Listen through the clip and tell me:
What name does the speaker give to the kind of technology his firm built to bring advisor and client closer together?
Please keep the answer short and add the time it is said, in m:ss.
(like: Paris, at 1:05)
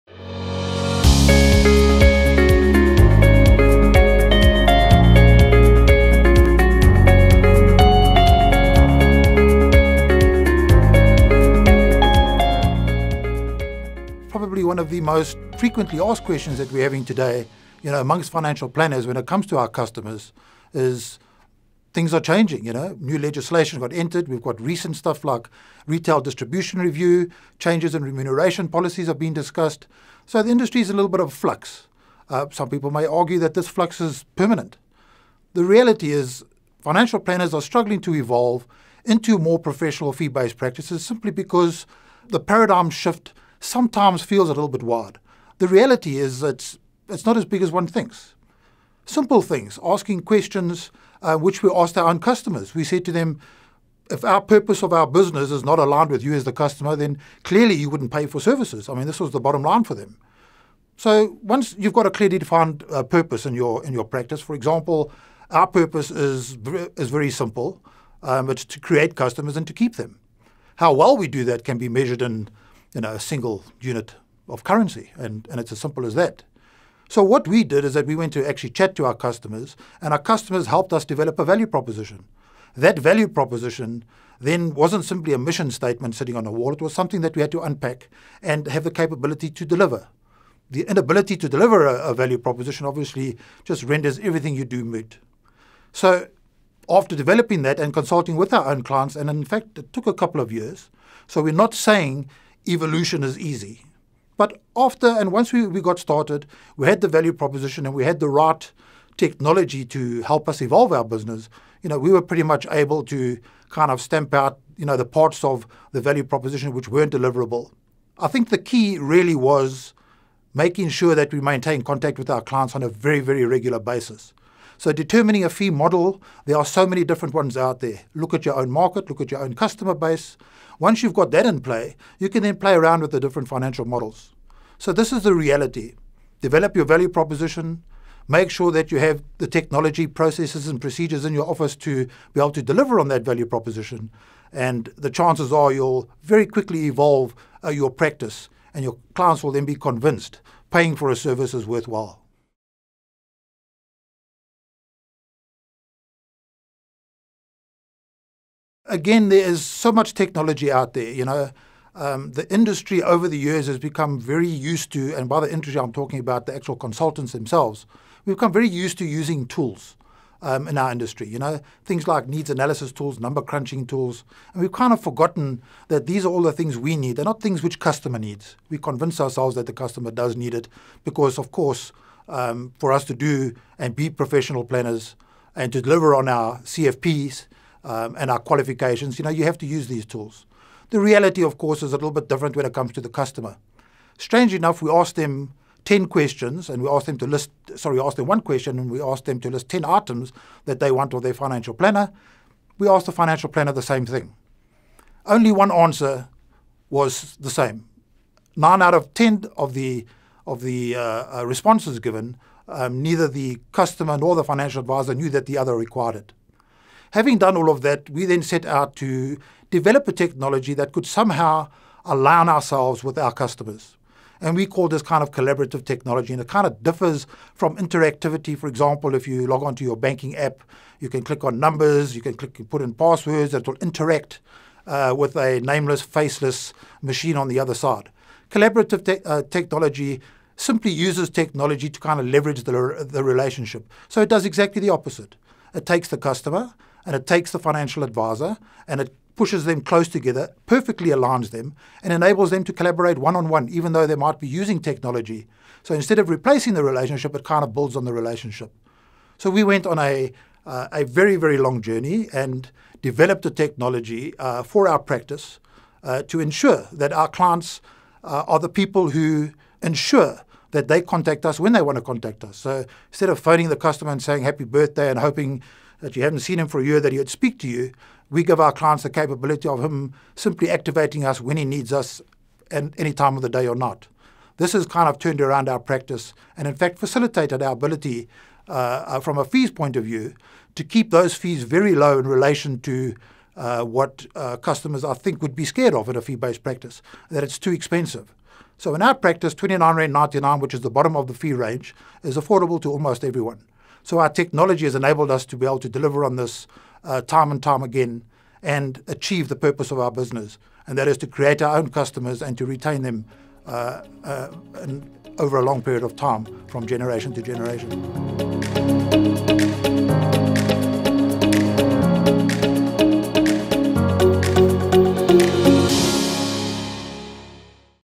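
Collaborative technology, at 3:45.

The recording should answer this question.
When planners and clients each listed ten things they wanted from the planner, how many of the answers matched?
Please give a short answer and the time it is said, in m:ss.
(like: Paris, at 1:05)
1, at 3:25.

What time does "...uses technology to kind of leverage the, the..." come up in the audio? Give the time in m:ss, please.
4:00.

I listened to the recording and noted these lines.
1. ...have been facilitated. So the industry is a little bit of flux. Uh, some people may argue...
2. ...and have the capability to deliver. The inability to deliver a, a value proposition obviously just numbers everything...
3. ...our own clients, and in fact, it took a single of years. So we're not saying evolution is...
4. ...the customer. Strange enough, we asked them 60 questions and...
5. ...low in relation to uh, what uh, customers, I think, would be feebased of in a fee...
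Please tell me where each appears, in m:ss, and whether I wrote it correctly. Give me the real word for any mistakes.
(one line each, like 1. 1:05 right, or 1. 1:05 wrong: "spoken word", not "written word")
1. 0:29 wrong: "discussed", not "facilitated"
2. 1:28 wrong: "renders", not "numbers"
3. 1:38 wrong: "couple", not "single"
4. 3:13 wrong: "10", not "60"
5. 4:51 wrong: "scared", not "feebased".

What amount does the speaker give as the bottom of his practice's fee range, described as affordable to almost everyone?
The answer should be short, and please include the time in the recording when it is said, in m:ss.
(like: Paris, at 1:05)
29.99, at 4:59.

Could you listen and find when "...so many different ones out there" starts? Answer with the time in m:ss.
2:06.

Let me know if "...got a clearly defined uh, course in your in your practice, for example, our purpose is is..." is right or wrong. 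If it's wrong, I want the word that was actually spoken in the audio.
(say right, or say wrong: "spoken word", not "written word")
wrong: "purpose", not "course".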